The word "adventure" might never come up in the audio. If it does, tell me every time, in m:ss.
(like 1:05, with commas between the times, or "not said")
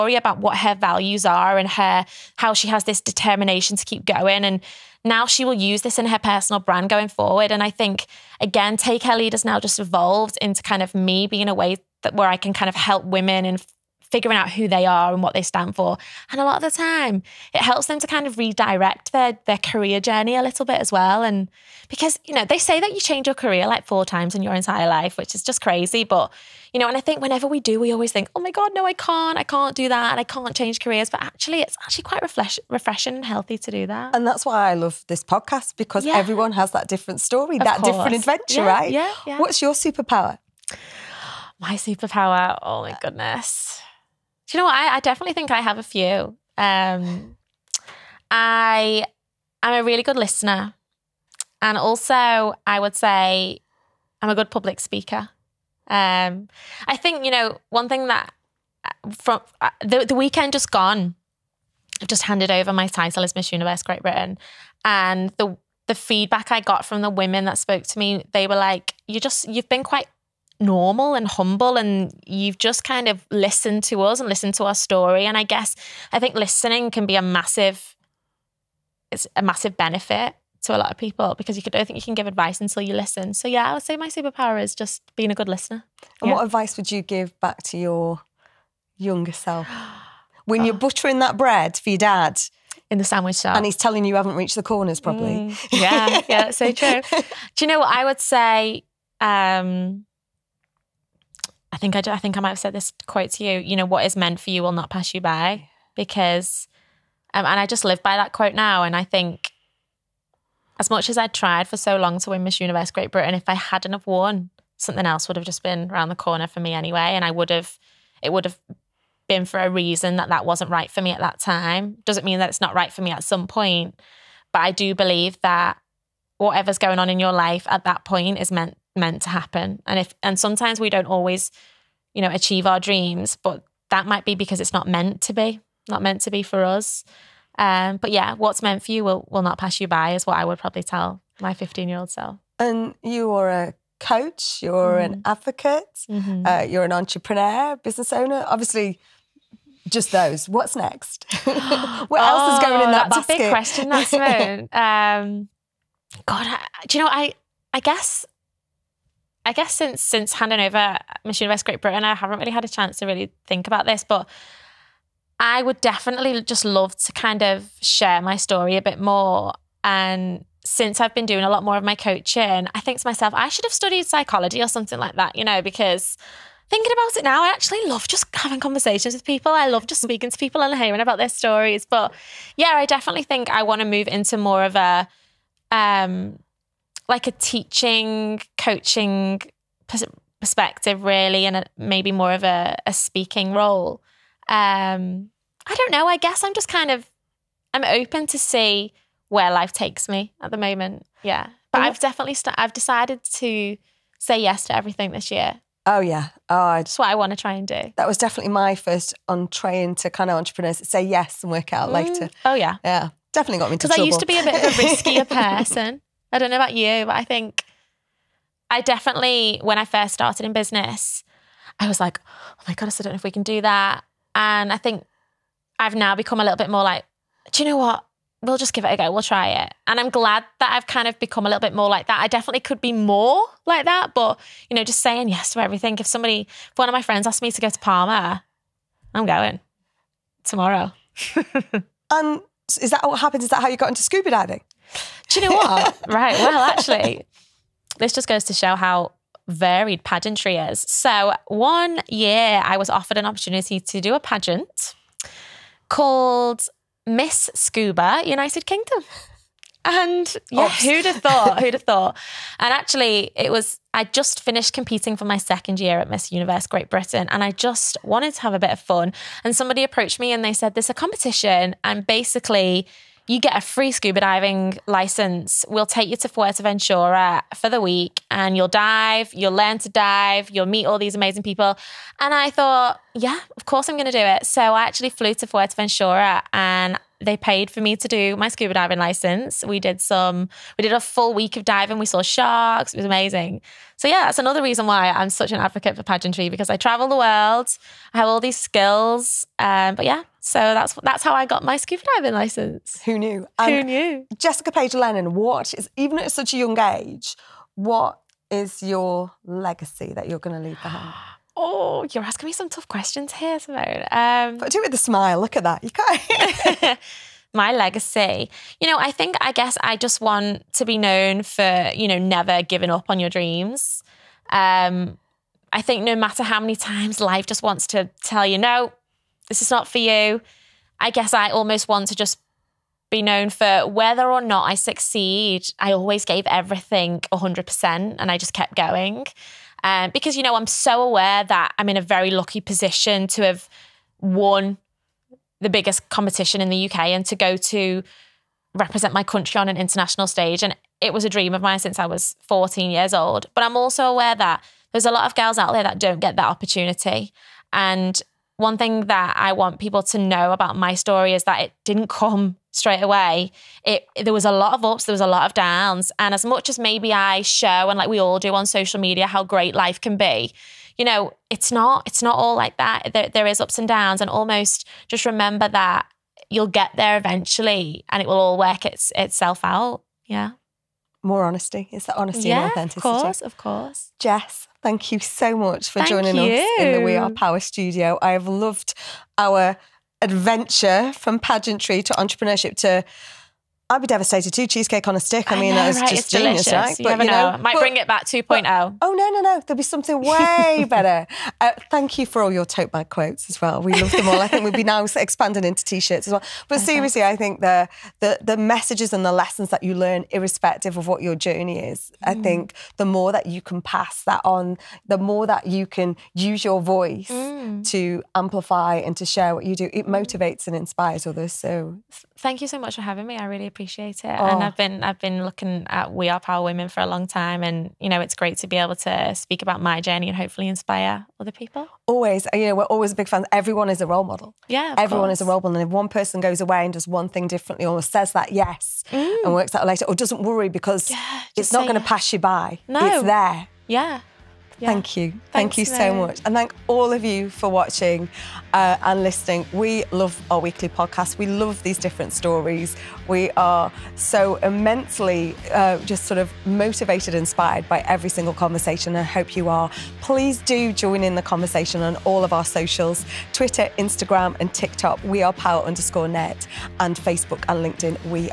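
0:38, 6:30.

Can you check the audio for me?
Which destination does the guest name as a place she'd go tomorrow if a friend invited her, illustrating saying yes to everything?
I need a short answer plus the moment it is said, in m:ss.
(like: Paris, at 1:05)
Palma, at 3:57.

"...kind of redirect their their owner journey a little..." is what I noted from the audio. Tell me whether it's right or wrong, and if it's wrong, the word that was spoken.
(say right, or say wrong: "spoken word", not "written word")
wrong: "career", not "owner".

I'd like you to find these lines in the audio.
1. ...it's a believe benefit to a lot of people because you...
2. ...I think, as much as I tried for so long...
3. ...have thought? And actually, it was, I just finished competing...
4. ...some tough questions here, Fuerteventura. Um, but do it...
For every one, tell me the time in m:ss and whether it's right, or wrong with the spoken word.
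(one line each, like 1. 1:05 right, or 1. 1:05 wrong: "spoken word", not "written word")
1. 1:19 wrong: "massive", not "believe"
2. 1:48 right
3. 4:21 right
4. 5:12 wrong: "Simone", not "Fuerteventura".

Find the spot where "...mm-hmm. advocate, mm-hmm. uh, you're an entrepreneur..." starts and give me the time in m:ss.
2:25.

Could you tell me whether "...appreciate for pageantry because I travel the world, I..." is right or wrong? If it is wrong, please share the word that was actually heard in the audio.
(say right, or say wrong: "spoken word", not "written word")
wrong: "advocate", not "appreciate".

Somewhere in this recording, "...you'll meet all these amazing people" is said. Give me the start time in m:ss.
4:40.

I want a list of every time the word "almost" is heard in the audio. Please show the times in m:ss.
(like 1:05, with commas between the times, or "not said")
5:31, 6:14.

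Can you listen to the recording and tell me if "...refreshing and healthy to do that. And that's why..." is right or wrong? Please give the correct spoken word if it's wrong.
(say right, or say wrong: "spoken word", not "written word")
right.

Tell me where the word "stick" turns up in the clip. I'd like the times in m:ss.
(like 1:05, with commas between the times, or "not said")
6:35.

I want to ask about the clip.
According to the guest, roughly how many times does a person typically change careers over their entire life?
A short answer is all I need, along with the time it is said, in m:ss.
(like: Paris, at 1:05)
4, at 0:23.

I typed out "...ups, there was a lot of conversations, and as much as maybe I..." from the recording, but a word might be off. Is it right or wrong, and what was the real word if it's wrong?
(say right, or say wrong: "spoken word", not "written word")
wrong: "downs", not "conversations".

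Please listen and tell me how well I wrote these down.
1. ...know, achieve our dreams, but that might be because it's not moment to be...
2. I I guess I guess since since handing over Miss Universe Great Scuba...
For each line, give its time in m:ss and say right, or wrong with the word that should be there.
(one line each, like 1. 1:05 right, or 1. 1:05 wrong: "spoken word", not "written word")
1. 2:12 wrong: "meant", not "moment"
2. 2:37 wrong: "Britain", not "Scuba".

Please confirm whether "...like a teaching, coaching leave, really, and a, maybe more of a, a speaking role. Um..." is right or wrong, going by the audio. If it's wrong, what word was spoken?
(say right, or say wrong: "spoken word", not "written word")
wrong: "perspective", not "leave".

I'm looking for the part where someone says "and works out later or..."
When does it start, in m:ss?
7:19.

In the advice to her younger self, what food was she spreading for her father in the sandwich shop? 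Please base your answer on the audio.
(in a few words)
Bread.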